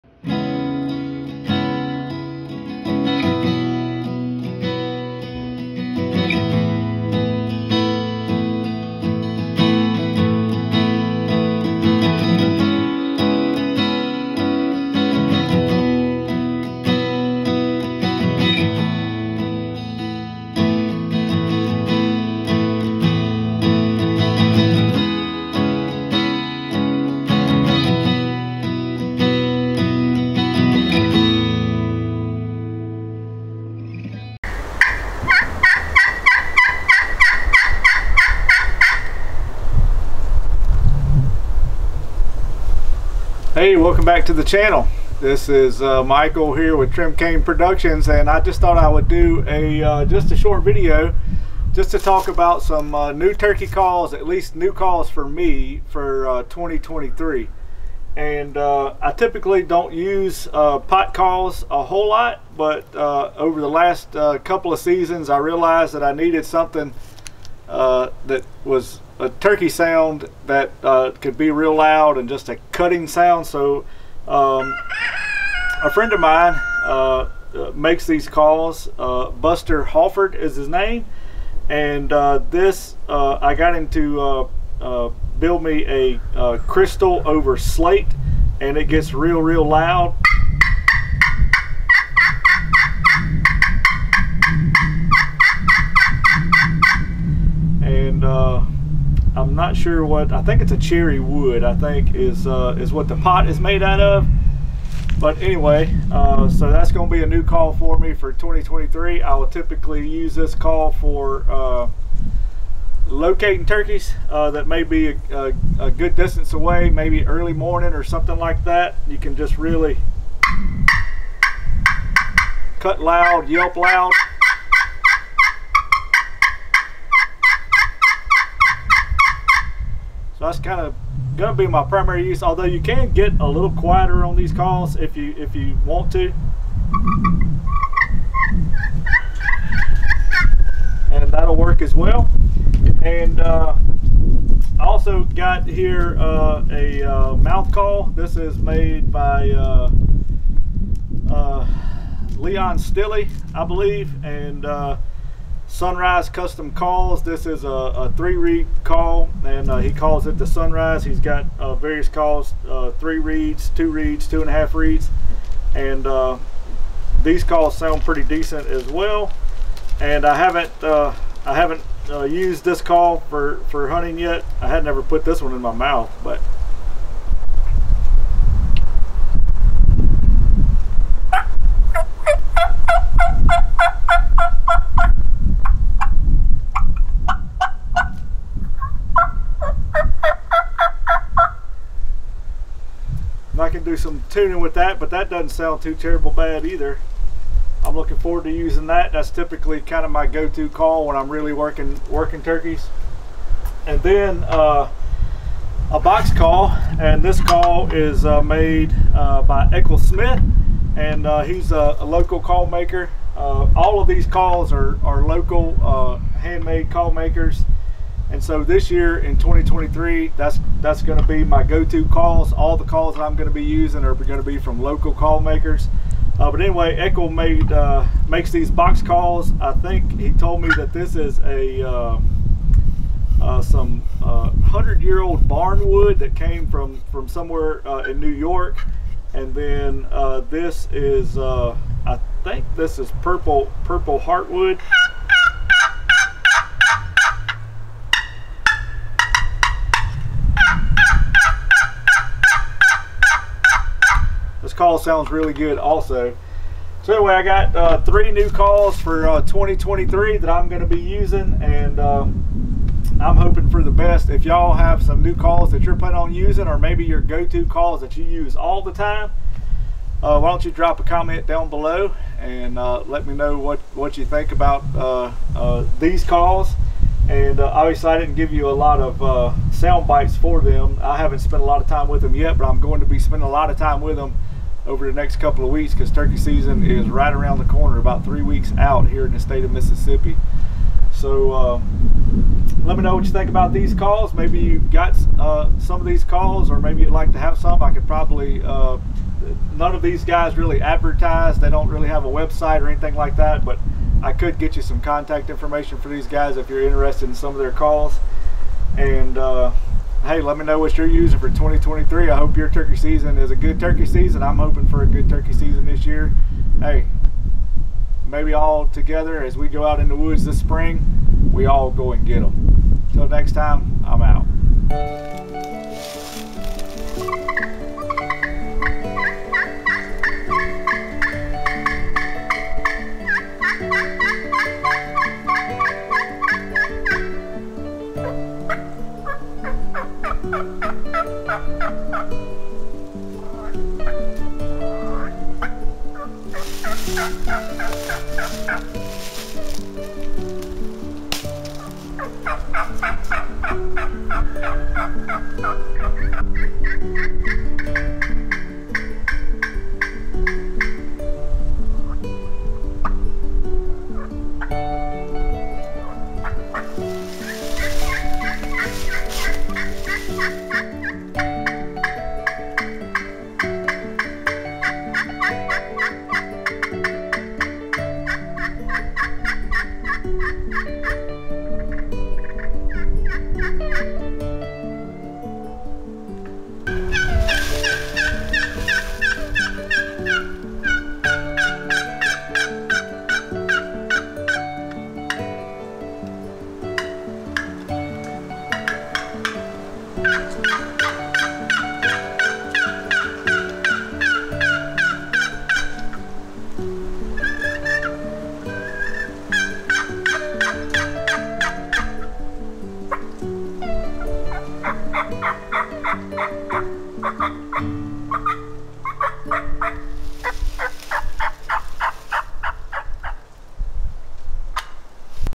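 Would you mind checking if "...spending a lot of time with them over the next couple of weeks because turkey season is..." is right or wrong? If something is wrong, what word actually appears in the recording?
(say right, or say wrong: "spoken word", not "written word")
right.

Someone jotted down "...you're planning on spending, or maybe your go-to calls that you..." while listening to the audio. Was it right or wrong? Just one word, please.
wrong.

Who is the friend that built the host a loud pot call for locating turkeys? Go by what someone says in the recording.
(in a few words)
Buster Halford.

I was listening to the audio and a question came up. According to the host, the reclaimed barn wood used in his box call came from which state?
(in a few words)
New York.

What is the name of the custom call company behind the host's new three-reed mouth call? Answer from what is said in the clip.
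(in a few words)
Sunrise Custom Calls.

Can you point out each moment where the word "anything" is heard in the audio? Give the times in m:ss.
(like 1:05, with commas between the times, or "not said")
5:02.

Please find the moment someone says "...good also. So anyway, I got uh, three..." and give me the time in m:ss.
4:15.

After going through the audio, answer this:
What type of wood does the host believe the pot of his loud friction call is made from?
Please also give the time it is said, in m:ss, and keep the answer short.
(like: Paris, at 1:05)
Cherry, at 1:40.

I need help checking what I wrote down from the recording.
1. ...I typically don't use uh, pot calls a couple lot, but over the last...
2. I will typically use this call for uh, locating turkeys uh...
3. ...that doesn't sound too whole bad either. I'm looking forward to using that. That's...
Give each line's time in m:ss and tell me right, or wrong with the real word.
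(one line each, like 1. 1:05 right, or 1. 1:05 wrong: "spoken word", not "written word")
1. 0:58 wrong: "whole", not "couple"
2. 1:49 right
3. 3:15 wrong: "terrible", not "whole".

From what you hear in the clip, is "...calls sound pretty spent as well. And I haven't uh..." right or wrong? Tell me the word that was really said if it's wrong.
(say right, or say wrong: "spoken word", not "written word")
wrong: "decent", not "spent".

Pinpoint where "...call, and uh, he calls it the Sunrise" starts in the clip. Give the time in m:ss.
2:38.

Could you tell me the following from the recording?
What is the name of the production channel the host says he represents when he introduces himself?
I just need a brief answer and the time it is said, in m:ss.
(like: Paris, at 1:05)
Trim Cane Productions, at 0:46.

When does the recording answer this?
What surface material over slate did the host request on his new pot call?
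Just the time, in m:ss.
1:26.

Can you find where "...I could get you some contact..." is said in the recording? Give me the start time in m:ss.
5:04.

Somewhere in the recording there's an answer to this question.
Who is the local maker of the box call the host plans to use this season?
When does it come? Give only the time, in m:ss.
3:29.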